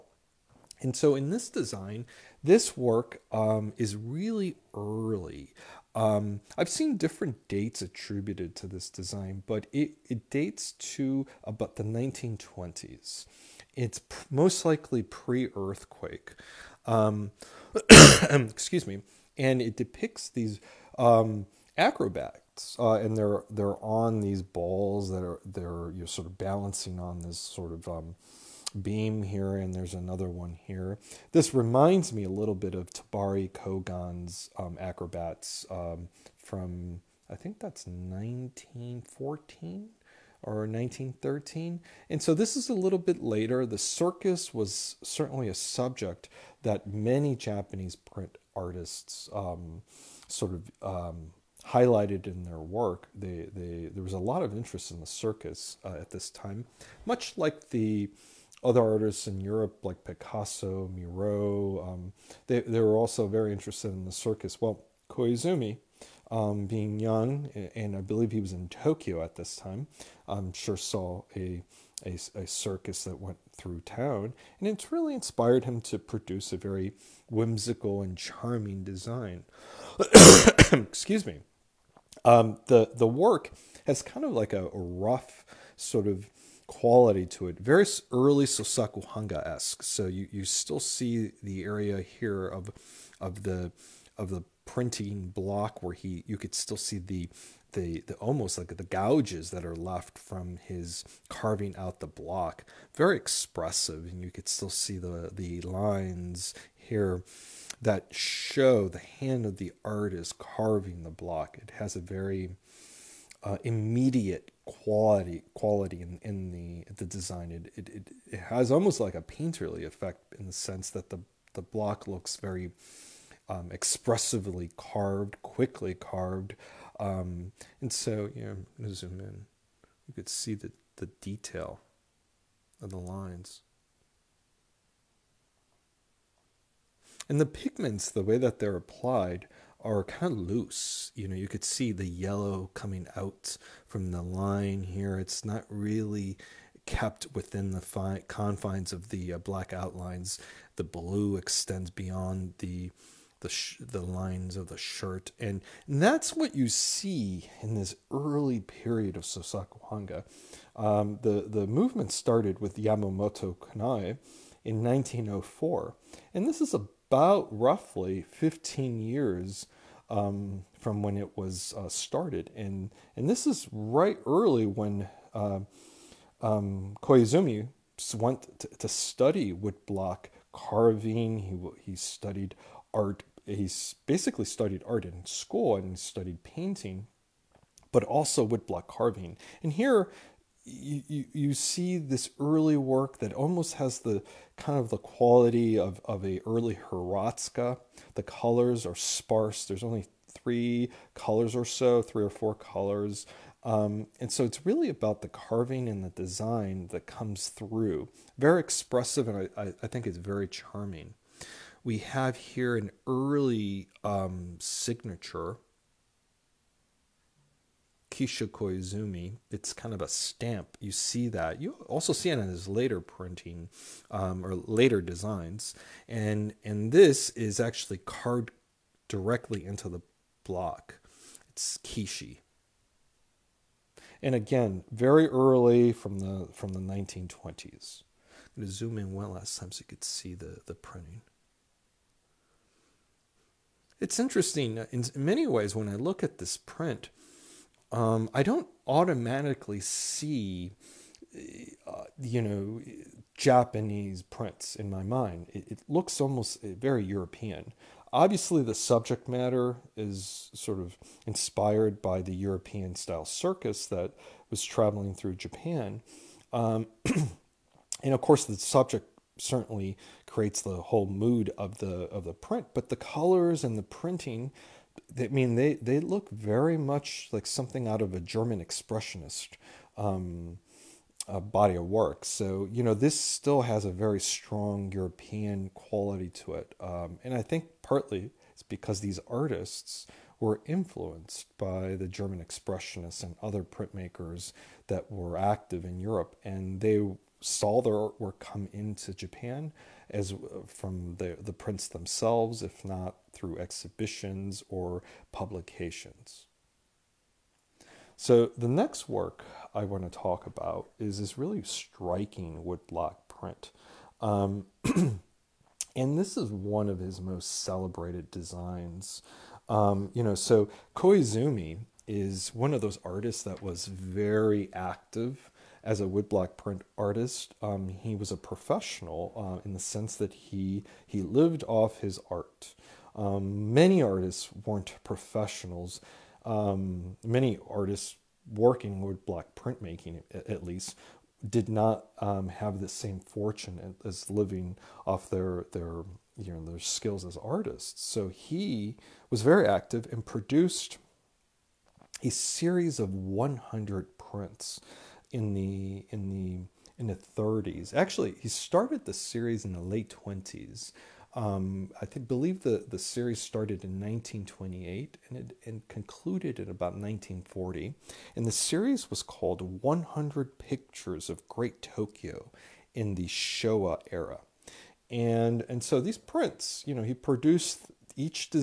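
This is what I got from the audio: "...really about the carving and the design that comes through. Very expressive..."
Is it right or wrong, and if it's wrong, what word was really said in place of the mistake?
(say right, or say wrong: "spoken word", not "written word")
right.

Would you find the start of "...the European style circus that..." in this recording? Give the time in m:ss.
4:22.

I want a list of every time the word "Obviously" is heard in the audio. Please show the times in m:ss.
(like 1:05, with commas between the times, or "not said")
4:18.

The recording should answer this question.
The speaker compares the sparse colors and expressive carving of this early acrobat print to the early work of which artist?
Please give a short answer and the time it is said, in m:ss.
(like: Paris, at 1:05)
Hiratsuka, at 3:16.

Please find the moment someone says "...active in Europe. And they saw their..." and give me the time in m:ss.
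4:55.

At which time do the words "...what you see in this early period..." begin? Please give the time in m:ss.
2:36.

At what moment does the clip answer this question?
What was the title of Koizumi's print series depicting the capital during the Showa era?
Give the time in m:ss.
6:09.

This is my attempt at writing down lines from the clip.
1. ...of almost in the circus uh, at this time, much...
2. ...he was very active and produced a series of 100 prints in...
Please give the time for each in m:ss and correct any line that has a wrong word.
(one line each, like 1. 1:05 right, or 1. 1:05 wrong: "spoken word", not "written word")
1. 0:54 wrong: "interest", not "almost"
2. 5:48 right.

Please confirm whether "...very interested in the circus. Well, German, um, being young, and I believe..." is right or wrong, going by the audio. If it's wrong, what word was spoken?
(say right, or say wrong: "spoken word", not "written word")
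wrong: "Koizumi", not "German".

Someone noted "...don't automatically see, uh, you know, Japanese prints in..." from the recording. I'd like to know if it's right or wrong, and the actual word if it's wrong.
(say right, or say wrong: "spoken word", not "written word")
right.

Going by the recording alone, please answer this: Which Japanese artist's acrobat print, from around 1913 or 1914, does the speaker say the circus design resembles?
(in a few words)
Tobari Kogan.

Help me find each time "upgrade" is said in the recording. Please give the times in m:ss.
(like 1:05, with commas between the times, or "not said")
not said.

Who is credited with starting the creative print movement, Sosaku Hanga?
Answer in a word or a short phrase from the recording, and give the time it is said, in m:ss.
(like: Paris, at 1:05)
Yamamoto Kanae, at 2:42.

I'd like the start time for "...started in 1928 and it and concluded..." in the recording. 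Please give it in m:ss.
6:03.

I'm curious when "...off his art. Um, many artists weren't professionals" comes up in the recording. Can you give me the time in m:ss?
5:31.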